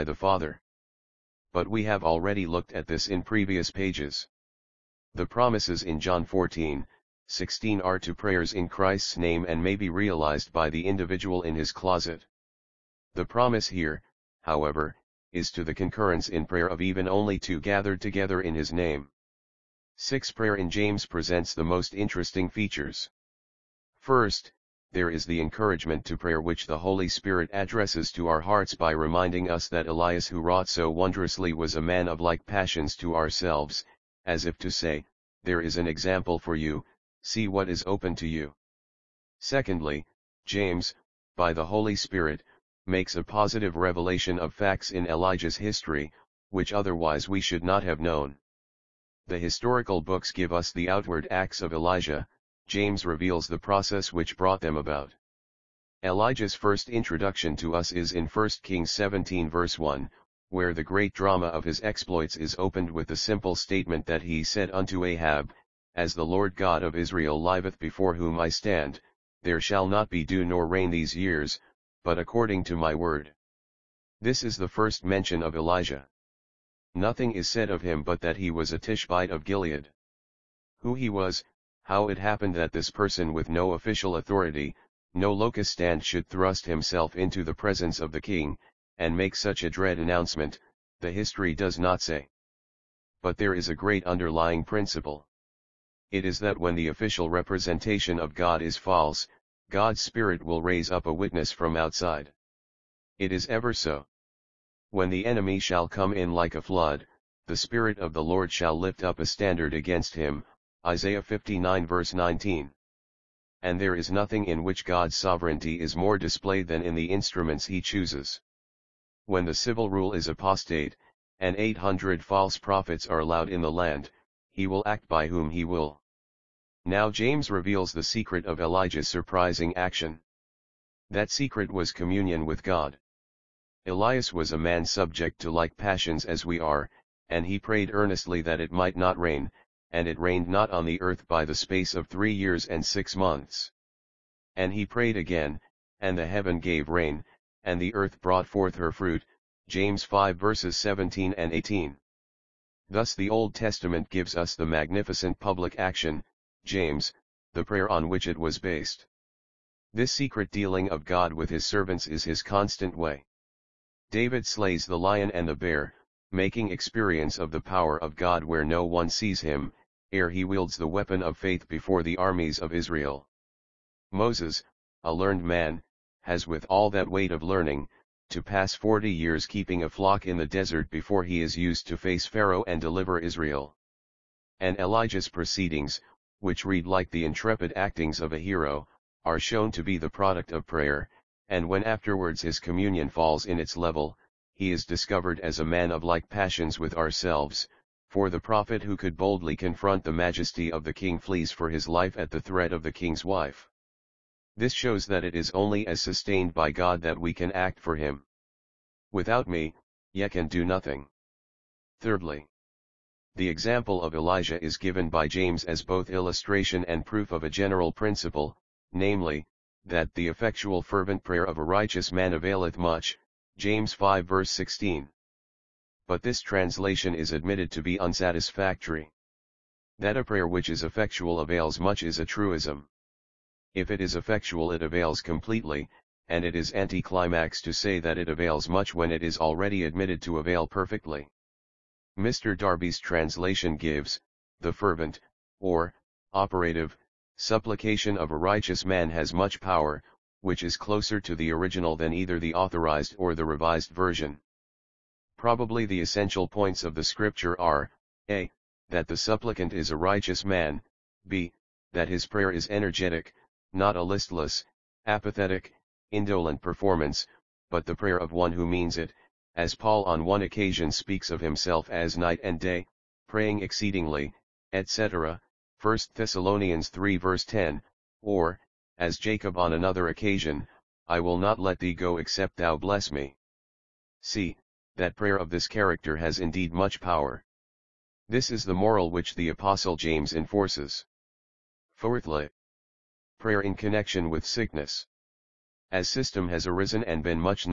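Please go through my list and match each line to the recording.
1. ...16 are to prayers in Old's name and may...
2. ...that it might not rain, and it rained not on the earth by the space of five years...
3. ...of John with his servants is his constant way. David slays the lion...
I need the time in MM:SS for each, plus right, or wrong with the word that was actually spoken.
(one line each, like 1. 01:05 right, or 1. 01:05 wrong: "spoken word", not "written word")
1. 00:07 wrong: "Christ", not "Old"
2. 02:18 wrong: "three", not "five"
3. 02:40 wrong: "God", not "John".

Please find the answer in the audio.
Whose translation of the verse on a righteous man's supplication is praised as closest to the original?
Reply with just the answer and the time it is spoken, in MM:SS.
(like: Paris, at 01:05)
Mr. Darby, at 04:02.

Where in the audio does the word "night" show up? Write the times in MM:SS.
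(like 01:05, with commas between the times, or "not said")
04:32.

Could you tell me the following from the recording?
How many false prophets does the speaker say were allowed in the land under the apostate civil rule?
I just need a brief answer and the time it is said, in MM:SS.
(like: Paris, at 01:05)
800, at 02:01.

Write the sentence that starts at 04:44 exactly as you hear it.
See, that prayer of this character has indeed much power.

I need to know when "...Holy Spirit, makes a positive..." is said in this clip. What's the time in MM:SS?
00:41.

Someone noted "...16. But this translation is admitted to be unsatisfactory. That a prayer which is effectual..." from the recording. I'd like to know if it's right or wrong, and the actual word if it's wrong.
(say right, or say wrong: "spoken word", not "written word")
right.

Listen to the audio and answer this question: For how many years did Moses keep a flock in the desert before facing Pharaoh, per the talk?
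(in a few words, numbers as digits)
40.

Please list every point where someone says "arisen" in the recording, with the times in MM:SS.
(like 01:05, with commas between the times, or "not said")
04:56.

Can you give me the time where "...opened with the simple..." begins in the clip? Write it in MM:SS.
01:02.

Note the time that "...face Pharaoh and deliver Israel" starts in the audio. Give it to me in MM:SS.
03:01.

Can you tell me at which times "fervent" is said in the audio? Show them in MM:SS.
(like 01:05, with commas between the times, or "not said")
03:40, 04:04.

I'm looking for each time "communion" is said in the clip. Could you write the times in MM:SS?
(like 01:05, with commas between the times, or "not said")
02:11, 03:12.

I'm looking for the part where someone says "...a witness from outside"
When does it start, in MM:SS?
01:41.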